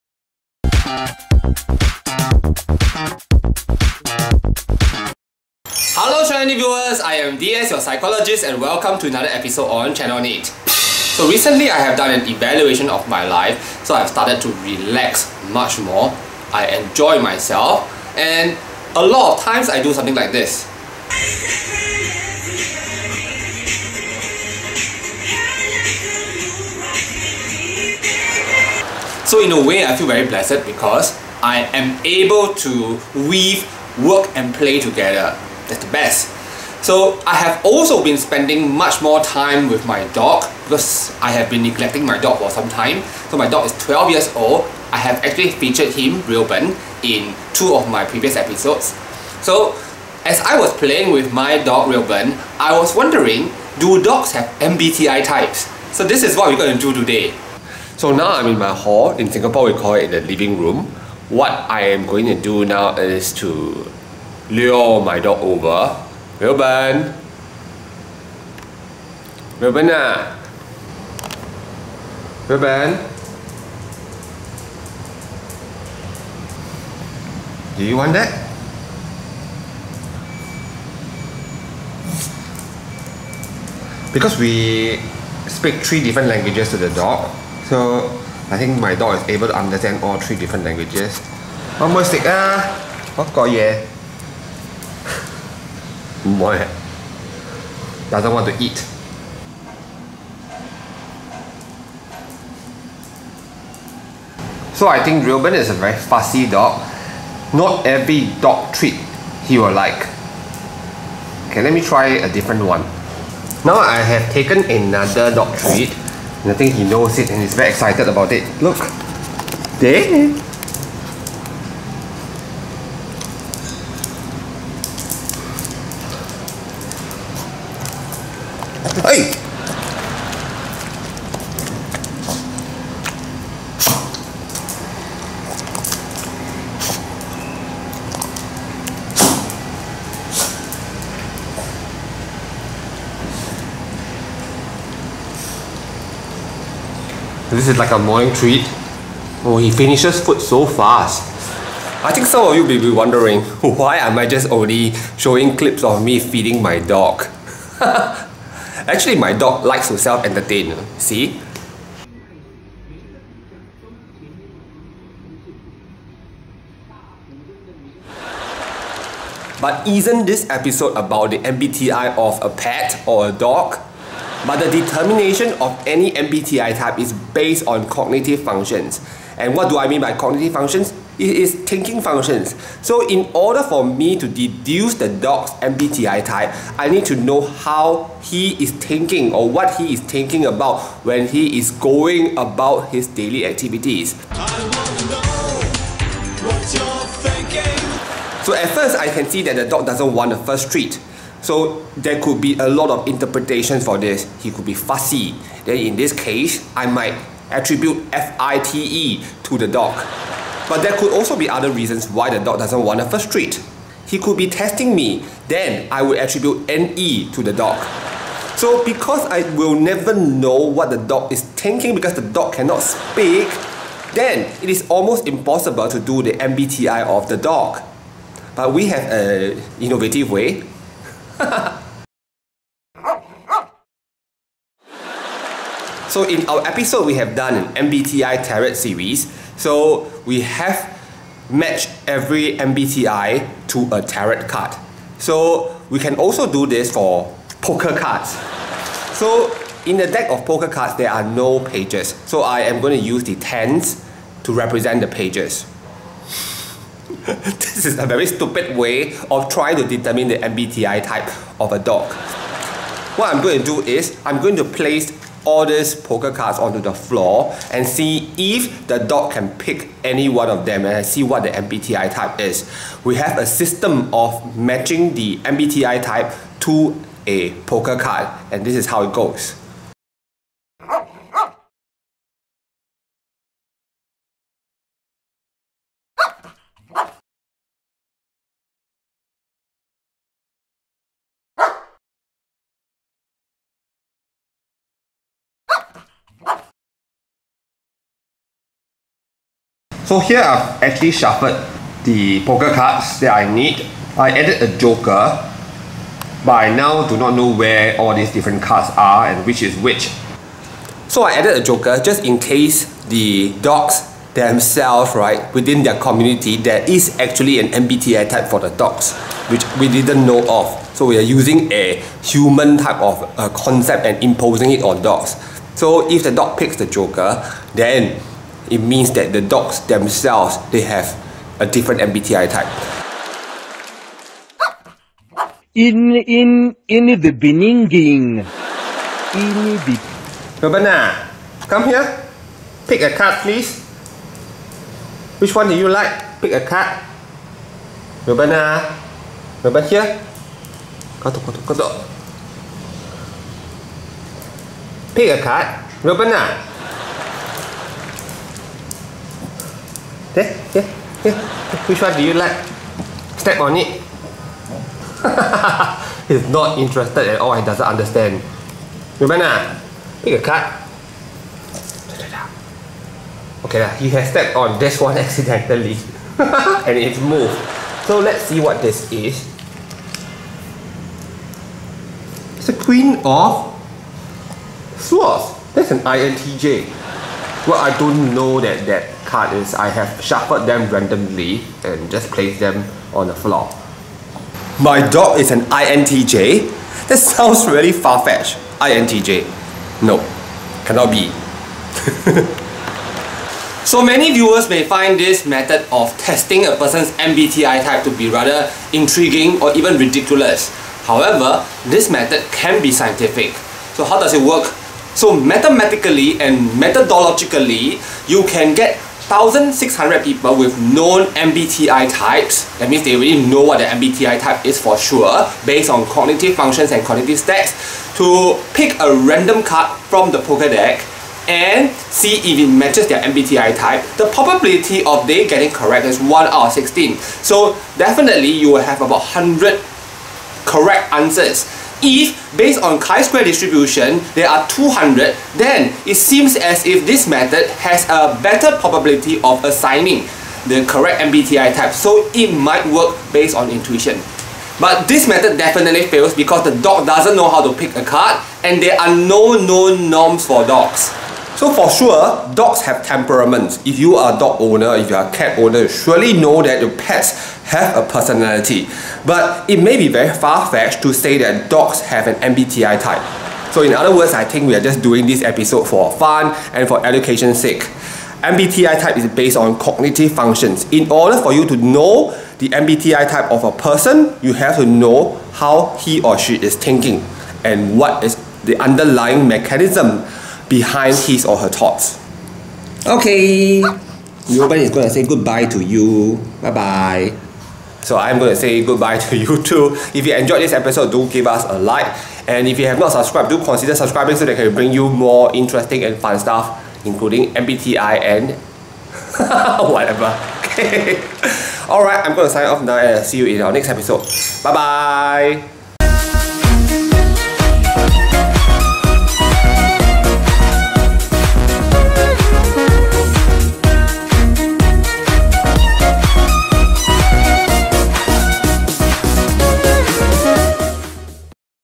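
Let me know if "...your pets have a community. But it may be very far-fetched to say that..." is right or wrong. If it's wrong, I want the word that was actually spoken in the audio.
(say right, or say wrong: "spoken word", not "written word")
wrong: "personality", not "community".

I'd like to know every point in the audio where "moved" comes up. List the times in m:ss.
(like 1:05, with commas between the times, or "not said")
6:17.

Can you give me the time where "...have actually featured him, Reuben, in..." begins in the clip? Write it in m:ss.
0:44.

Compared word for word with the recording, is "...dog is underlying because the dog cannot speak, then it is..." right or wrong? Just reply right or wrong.
wrong.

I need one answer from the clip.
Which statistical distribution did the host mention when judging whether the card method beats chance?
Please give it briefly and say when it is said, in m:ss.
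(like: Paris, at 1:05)
chi-square distribution, at 7:22.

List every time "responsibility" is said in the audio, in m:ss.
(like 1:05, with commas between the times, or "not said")
not said.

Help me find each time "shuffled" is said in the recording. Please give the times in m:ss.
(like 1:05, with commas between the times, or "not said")
5:01, 6:30.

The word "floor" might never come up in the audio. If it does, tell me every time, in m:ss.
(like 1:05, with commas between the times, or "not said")
4:26, 6:33.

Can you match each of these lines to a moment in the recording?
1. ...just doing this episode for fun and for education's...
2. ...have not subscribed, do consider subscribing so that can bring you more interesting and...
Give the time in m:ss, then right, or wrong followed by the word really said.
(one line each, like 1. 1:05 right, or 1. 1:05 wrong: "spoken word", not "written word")
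1. 7:54 right
2. 8:22 right.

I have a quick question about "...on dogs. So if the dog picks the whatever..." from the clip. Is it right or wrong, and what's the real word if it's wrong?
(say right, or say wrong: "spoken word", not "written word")
wrong: "joker", not "whatever".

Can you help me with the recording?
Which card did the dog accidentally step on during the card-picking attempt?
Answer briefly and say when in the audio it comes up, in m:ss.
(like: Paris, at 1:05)
queen of swords, at 6:22.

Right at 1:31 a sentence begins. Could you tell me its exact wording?
One more stick ah, what got yeah?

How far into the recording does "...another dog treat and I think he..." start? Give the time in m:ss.
1:54.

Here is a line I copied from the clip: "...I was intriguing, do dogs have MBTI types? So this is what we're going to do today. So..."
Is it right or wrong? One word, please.
wrong.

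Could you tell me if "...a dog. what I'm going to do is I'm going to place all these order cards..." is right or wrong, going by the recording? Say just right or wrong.
wrong.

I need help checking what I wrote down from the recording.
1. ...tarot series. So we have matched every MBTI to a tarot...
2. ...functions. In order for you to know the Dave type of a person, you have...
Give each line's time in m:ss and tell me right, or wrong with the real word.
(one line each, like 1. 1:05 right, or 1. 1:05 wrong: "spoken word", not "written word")
1. 3:58 right
2. 8:00 wrong: "MBTI", not "Dave".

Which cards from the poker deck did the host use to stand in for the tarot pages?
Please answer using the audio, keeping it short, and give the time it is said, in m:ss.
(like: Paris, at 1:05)
the tens, at 4:13.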